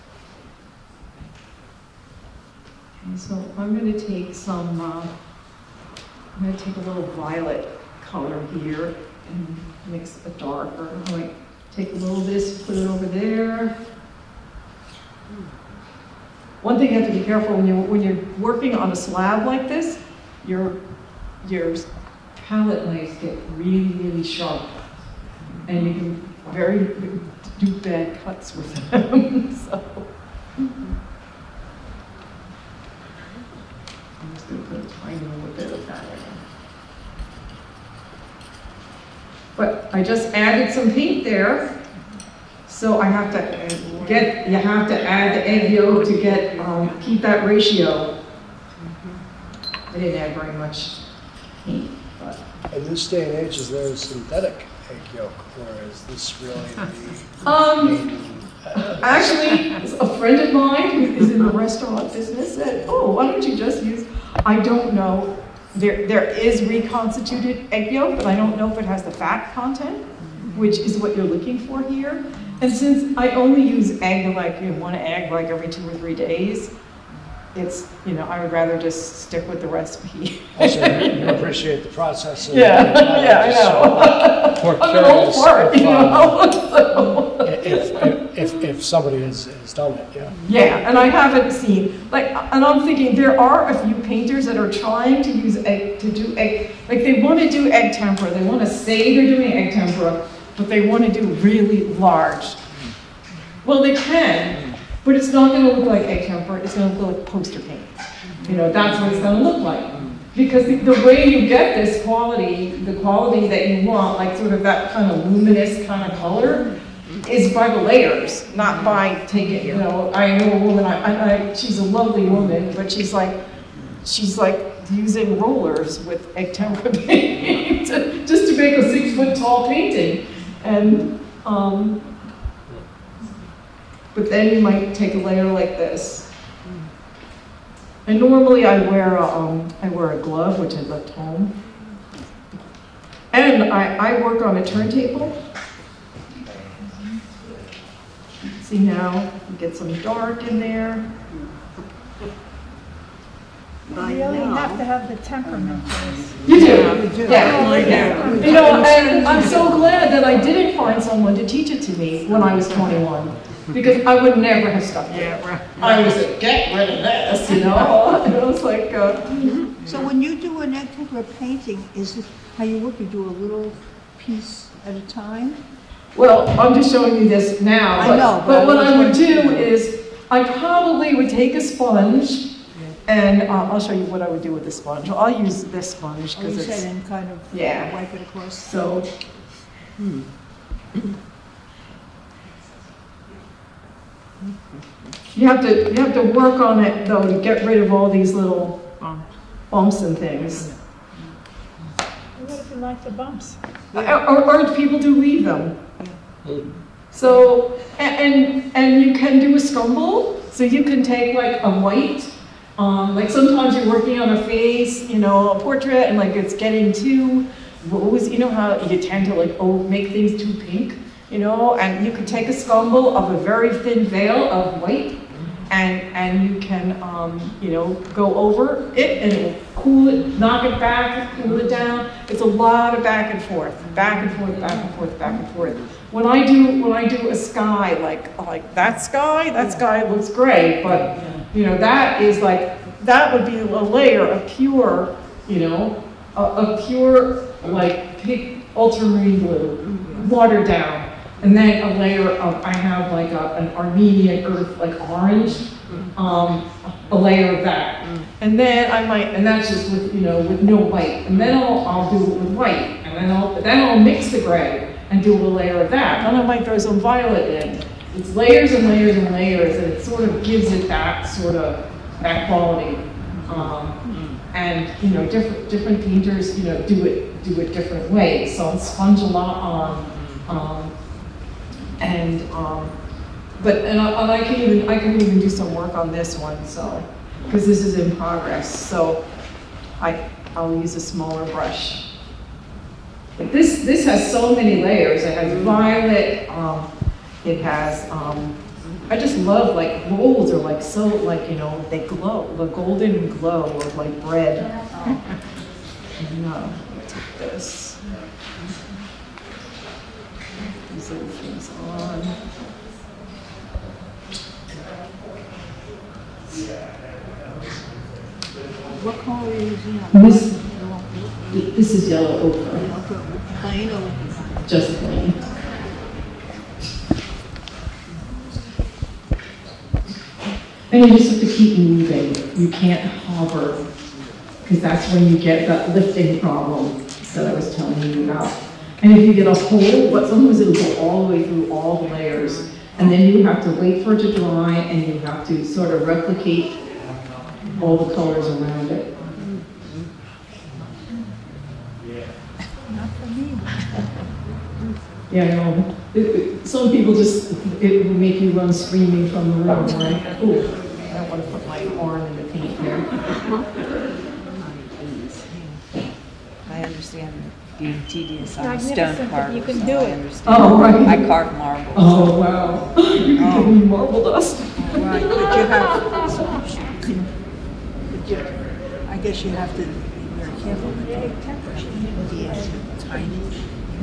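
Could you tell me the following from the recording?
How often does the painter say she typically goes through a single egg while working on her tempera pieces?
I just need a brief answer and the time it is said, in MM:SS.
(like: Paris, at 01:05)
every two or three days, at 01:15.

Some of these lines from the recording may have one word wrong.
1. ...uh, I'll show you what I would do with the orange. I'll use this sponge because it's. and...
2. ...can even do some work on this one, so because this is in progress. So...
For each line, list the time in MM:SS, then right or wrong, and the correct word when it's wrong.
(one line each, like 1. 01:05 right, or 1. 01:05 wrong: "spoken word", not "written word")
1. 03:03 wrong: "sponge", not "orange"
2. 04:44 right.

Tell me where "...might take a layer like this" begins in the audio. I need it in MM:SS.
02:14.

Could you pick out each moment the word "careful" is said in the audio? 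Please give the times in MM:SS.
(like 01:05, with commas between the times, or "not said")
00:17, 06:20.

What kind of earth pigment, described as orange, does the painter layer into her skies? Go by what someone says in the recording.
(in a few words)
Armenian earth.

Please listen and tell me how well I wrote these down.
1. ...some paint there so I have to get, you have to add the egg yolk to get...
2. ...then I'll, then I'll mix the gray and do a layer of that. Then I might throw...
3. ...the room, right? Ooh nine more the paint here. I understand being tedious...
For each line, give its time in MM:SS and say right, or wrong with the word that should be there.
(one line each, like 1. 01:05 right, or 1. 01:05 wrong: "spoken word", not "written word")
1. 00:40 right
2. 04:23 right
3. 05:59 wrong: "two", not "nine".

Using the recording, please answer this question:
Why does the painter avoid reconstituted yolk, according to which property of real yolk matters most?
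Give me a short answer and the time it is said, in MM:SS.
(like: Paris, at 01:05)
fat content, at 01:09.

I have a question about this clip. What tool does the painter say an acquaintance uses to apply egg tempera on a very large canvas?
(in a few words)
rollers.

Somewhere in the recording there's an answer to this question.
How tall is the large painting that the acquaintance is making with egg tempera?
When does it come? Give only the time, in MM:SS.
02:08.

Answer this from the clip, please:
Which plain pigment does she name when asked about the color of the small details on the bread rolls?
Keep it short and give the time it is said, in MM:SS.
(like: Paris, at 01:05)
yellow ochre, at 05:22.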